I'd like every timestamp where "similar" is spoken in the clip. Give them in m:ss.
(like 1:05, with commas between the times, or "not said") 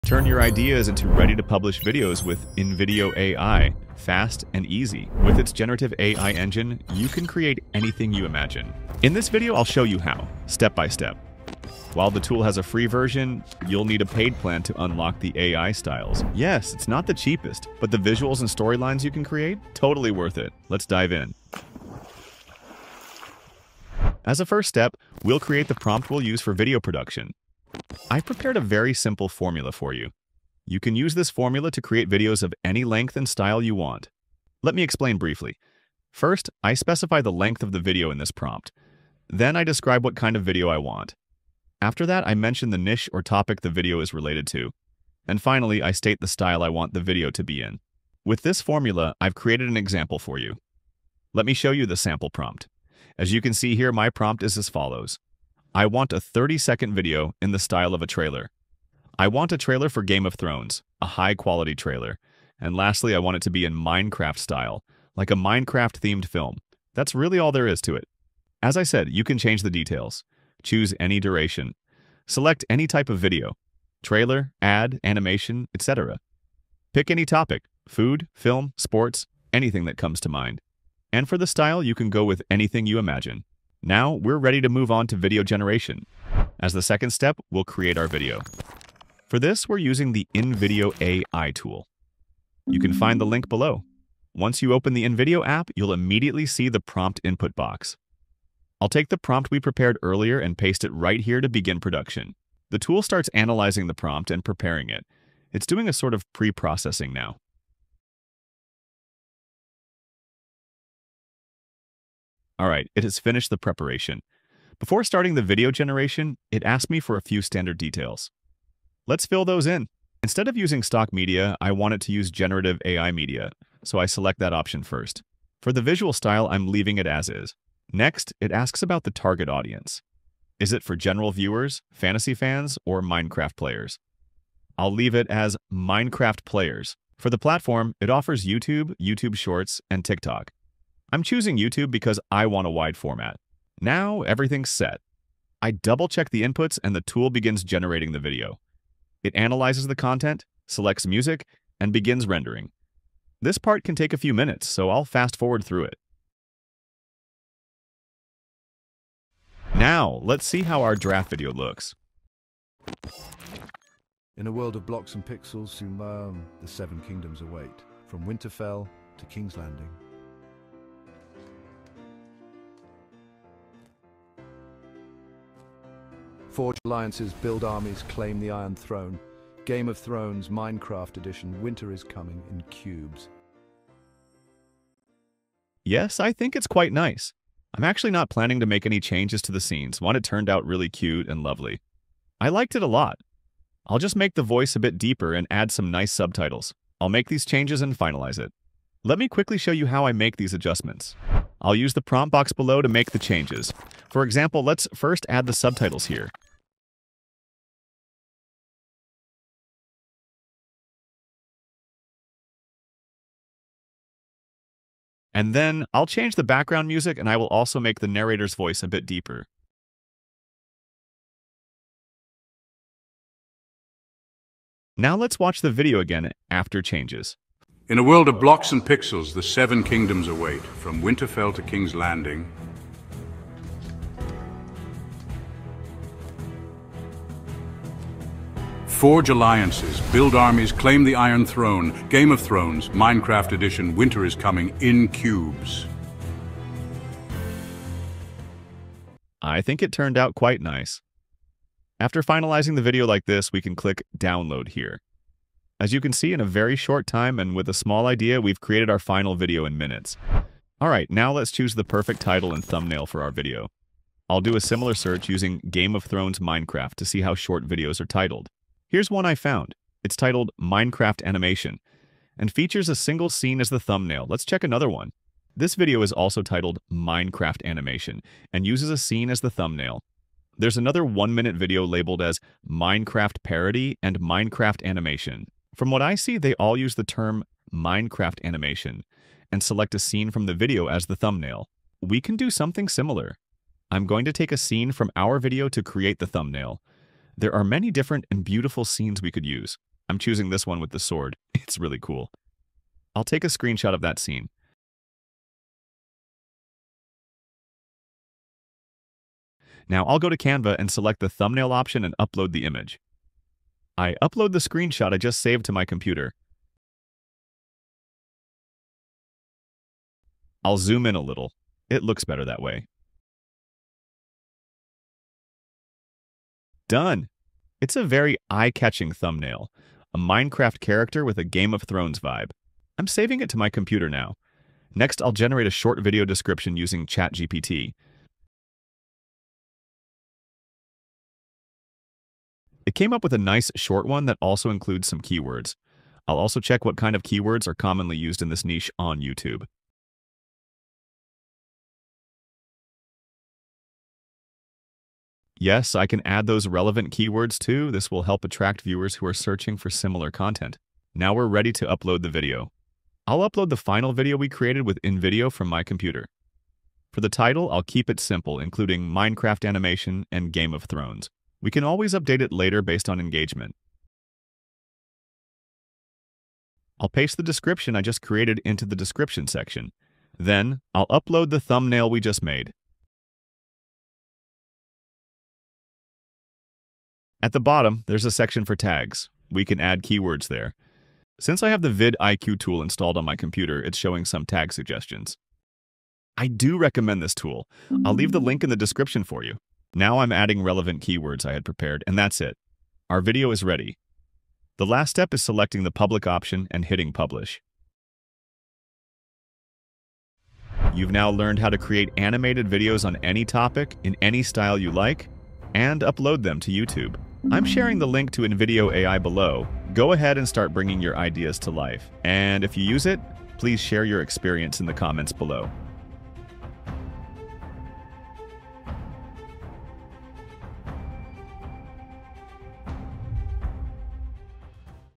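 4:24, 4:52, 5:59.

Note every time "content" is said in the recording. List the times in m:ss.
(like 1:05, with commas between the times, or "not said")
2:29, 6:00.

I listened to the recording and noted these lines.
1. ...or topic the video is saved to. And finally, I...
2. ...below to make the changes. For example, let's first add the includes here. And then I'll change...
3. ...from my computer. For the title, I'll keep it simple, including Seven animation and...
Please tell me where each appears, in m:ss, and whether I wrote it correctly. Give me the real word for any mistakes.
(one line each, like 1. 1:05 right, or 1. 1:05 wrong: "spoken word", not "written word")
1. 0:43 wrong: "related", not "saved"
2. 3:22 wrong: "subtitles", not "includes"
3. 6:05 wrong: "Minecraft", not "Seven".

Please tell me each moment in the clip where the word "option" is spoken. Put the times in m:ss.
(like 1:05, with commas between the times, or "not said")
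2:04, 5:11, 6:46.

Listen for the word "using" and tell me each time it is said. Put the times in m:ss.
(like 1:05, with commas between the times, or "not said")
1:29, 2:00, 4:25, 5:36.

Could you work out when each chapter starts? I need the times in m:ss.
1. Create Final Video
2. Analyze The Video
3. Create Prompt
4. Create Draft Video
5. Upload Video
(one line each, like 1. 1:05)
1. 3:21
2. 2:39
3. 0:24
4. 1:26
5. 4:20.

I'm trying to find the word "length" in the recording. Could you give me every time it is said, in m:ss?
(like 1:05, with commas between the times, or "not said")
0:32, 0:37.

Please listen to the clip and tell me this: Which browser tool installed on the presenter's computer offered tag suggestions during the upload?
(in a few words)
vidIQ.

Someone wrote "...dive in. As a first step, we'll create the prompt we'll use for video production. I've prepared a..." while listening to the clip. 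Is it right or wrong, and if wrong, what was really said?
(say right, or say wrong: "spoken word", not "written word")
right.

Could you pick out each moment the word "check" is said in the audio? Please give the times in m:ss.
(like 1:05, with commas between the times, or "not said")
2:26, 4:34, 5:46.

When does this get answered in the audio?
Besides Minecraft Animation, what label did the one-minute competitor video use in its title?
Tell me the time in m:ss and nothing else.
4:42.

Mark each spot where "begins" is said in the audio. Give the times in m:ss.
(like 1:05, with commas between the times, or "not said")
1:41, 2:27, 2:31.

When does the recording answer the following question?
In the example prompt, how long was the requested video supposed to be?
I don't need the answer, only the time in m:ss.
0:56.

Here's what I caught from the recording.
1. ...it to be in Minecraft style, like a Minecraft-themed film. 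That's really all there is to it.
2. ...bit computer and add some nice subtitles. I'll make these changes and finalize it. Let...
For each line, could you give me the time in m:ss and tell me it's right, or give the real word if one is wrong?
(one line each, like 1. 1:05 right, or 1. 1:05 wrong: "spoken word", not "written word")
1. 1:03 right
2. 3:14 wrong: "deeper", not "computer".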